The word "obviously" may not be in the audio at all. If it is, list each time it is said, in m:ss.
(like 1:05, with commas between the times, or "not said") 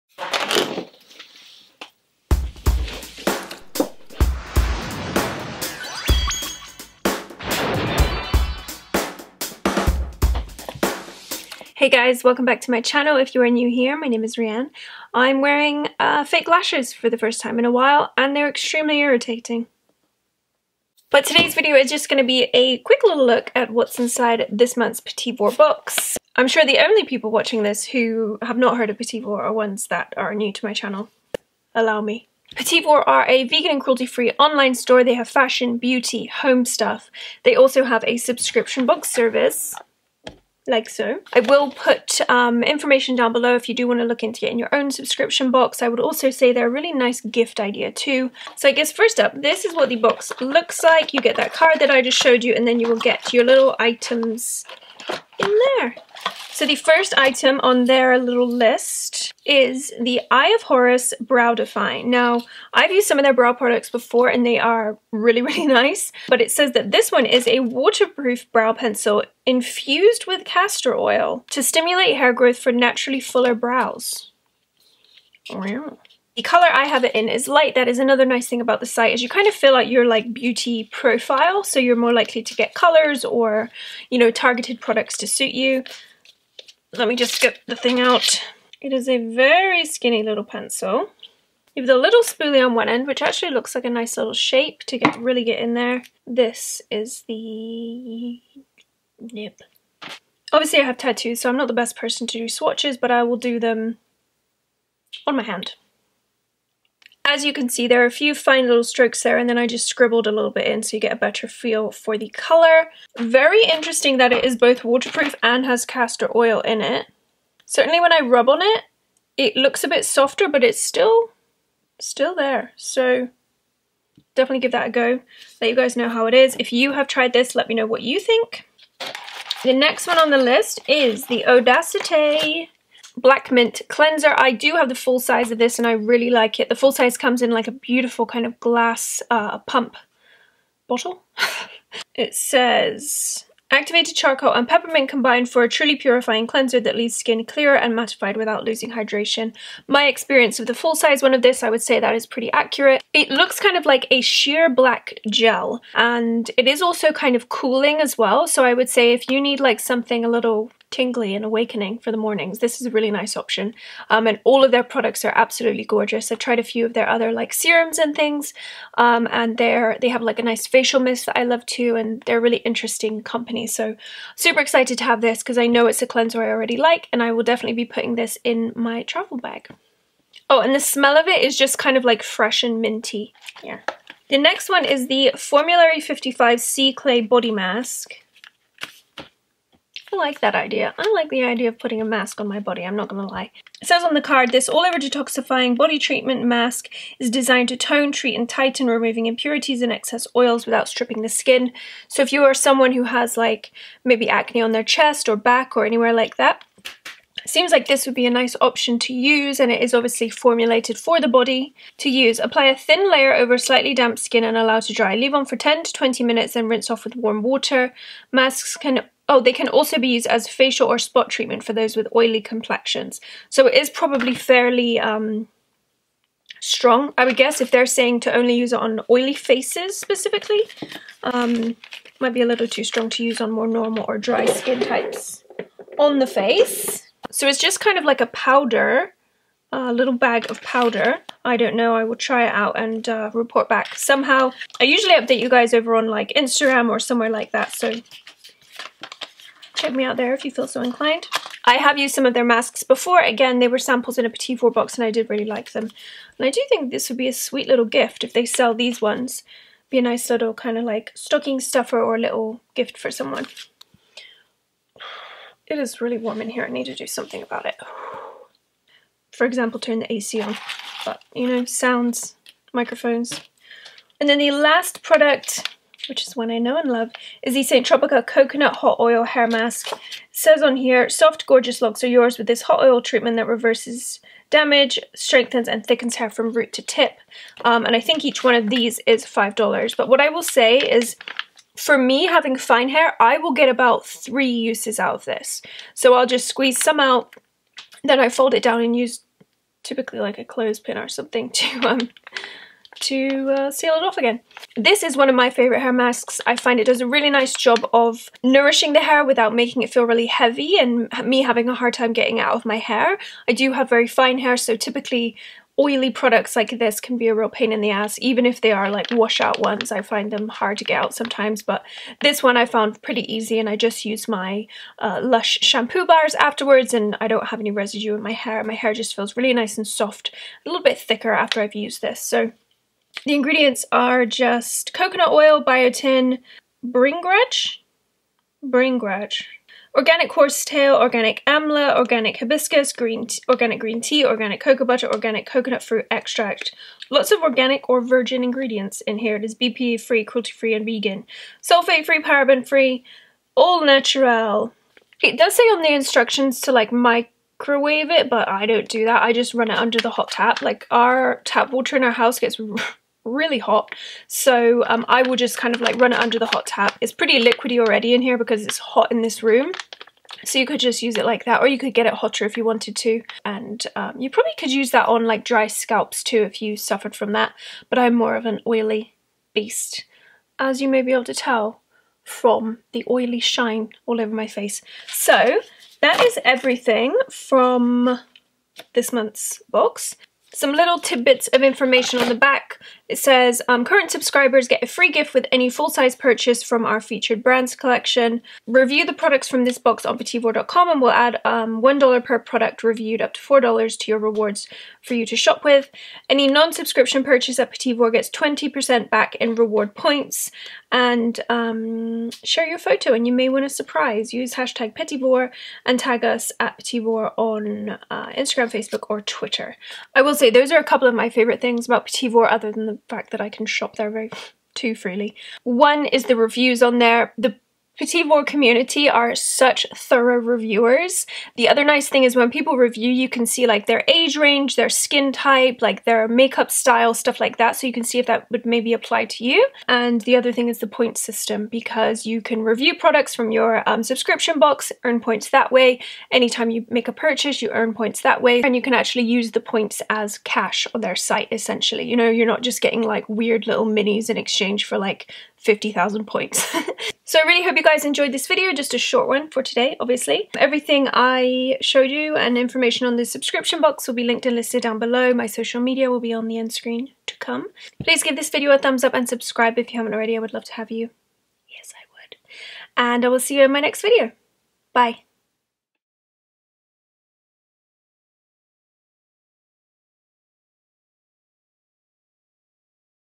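1:40, 3:29, 7:39.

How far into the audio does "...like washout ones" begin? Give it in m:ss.
5:18.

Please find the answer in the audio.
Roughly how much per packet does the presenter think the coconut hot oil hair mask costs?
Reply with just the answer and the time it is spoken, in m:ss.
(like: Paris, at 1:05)
$5, at 4:49.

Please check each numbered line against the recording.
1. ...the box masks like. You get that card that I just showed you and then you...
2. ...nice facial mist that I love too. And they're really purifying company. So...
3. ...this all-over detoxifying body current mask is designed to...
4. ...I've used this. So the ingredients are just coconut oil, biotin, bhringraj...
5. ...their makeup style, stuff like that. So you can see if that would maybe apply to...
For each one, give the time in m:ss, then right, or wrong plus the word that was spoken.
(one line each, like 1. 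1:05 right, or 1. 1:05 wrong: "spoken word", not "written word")
1. 0:49 wrong: "looks", not "masks"
2. 2:50 wrong: "interesting", not "purifying"
3. 3:14 wrong: "treatment", not "current"
4. 5:31 right
5. 7:16 right.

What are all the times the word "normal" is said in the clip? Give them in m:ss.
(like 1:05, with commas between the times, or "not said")
3:53.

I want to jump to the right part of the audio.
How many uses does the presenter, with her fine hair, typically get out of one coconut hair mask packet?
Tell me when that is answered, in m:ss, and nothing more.
4:54.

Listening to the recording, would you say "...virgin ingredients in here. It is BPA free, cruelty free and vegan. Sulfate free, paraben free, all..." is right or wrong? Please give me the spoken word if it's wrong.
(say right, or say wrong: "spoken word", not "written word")
right.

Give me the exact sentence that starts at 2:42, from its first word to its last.
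This is a really nice option.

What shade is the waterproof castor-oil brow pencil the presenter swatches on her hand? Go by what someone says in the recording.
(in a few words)
light.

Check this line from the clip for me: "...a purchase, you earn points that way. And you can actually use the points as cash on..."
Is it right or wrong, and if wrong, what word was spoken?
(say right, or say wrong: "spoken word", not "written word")
right.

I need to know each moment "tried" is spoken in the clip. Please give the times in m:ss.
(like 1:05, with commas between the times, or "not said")
2:07, 2:46.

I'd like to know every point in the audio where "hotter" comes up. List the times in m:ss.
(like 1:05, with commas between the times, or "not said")
6:12.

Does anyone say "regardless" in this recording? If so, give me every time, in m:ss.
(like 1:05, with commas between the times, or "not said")
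not said.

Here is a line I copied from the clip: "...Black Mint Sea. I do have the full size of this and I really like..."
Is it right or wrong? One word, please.
wrong.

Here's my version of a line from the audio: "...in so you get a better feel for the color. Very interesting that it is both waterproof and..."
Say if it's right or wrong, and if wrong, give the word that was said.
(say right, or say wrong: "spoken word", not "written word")
right.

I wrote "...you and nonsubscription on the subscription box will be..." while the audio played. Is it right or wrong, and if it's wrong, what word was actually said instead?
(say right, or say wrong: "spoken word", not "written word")
wrong: "information", not "nonsubscription".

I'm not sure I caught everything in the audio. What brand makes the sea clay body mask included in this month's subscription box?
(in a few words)
Formulary 55.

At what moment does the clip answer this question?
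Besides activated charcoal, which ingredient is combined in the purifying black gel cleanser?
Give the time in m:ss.
2:24.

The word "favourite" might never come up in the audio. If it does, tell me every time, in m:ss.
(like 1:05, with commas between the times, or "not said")
5:05, 7:01.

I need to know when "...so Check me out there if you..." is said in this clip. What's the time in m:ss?
4:07.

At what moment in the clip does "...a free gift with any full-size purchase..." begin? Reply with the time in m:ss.
6:34.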